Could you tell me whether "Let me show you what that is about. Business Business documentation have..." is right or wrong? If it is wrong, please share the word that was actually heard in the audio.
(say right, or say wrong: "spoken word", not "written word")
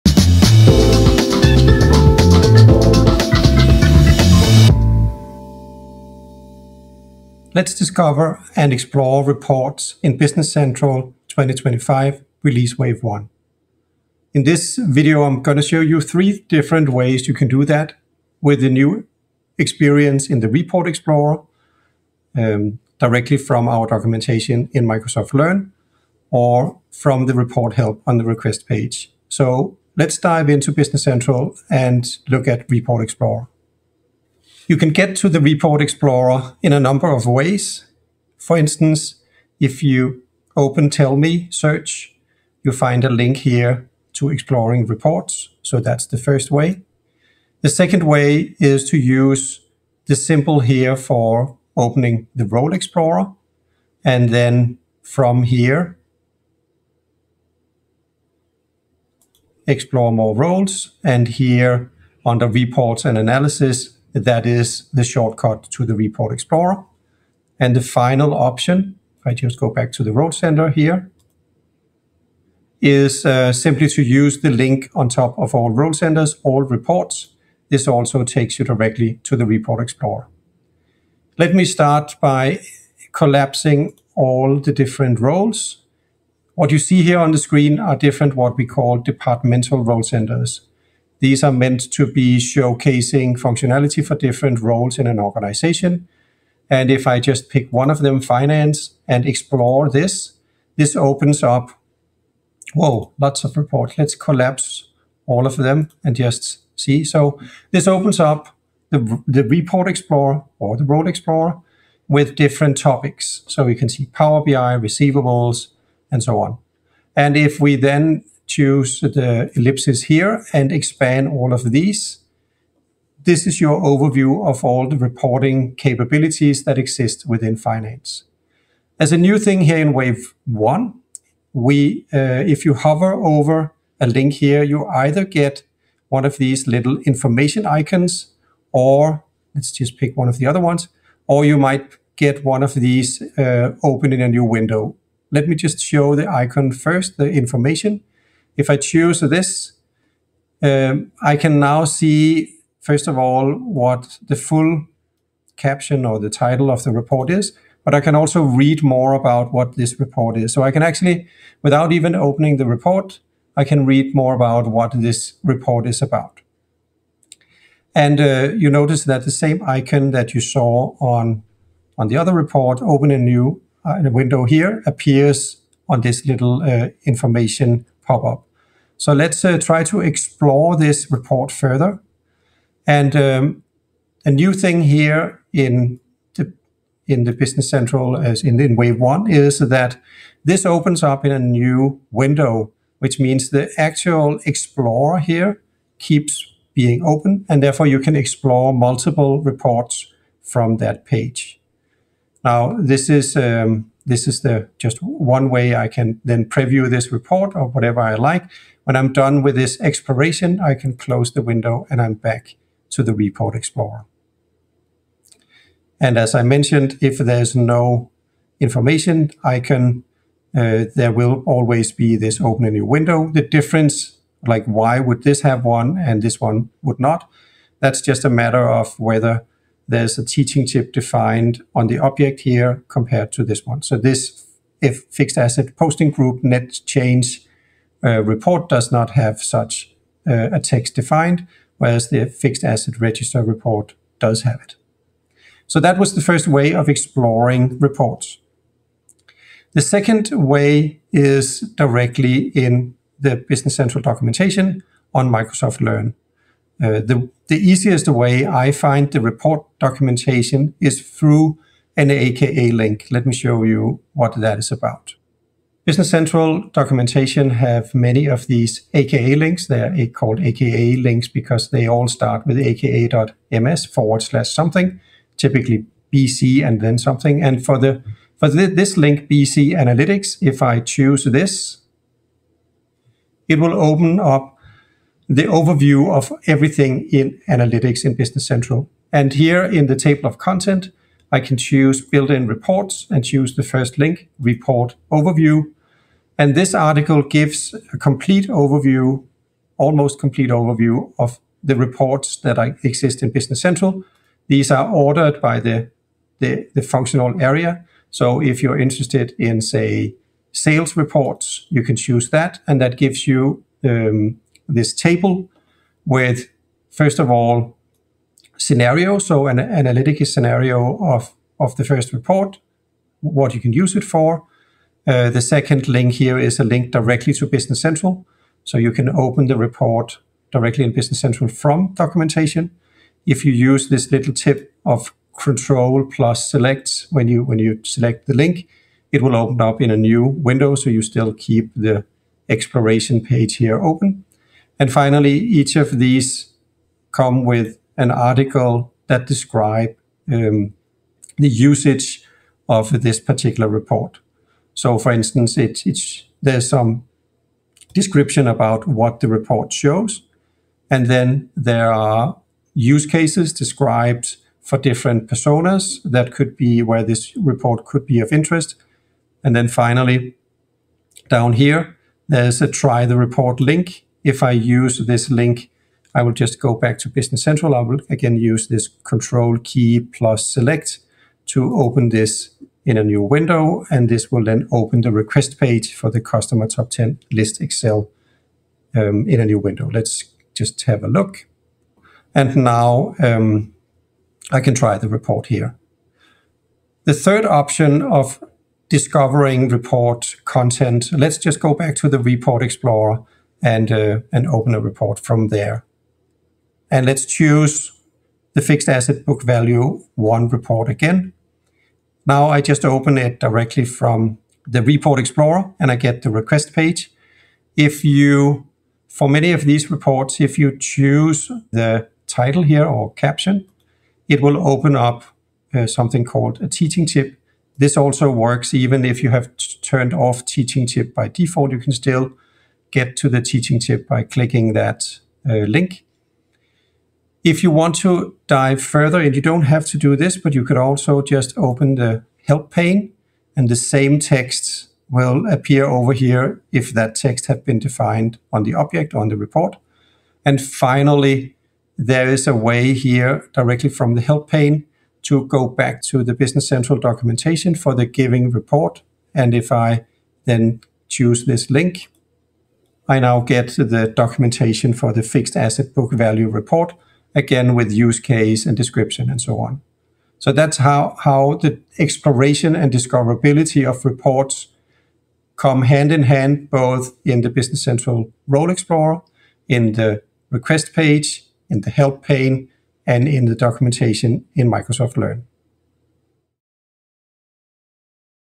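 wrong: "Central", not "Business".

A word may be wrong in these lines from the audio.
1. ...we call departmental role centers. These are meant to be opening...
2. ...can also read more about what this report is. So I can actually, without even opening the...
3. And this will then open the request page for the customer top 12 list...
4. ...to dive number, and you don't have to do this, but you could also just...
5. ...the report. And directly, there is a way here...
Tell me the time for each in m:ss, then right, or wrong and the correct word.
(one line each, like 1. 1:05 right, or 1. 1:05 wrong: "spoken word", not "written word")
1. 1:28 wrong: "showcasing", not "opening"
2. 2:38 right
3. 6:23 wrong: "10", not "12"
4. 7:18 wrong: "further", not "number"
5. 7:29 wrong: "finally", not "directly".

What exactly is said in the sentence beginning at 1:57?
And if we then choose the ellipses here and expand all of these.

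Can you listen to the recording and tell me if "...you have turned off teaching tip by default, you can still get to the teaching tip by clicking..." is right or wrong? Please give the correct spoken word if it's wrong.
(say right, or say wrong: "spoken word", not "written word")
right.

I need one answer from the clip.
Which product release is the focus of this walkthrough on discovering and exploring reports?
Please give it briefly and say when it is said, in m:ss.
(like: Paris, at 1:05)
2025 Release Wave 1, at 0:11.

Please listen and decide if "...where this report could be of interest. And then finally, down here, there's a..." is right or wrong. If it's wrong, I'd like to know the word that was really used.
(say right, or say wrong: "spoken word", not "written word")
right.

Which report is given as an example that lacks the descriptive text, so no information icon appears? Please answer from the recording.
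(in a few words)
Fixed asset posting group net change.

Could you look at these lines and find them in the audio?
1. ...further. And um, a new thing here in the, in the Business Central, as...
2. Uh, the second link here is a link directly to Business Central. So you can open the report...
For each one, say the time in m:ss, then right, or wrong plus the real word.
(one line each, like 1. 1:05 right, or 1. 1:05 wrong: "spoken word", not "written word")
1. 3:01 right
2. 5:25 right.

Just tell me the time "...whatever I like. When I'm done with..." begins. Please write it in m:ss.
3:27.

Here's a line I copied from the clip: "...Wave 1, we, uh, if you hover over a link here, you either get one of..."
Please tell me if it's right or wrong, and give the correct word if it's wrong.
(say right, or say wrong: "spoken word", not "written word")
right.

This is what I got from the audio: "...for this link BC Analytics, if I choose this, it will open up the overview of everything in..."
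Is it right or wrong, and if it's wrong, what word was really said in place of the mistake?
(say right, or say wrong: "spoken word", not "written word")
right.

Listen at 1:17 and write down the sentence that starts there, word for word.
This also takes you directly to the Report Explorer.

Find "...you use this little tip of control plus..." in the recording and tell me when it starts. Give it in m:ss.
5:33.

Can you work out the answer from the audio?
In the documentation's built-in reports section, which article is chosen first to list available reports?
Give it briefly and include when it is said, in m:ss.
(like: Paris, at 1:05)
Report overview, at 4:54.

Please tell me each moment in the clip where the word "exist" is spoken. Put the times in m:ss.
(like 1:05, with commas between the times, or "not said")
2:06, 5:02.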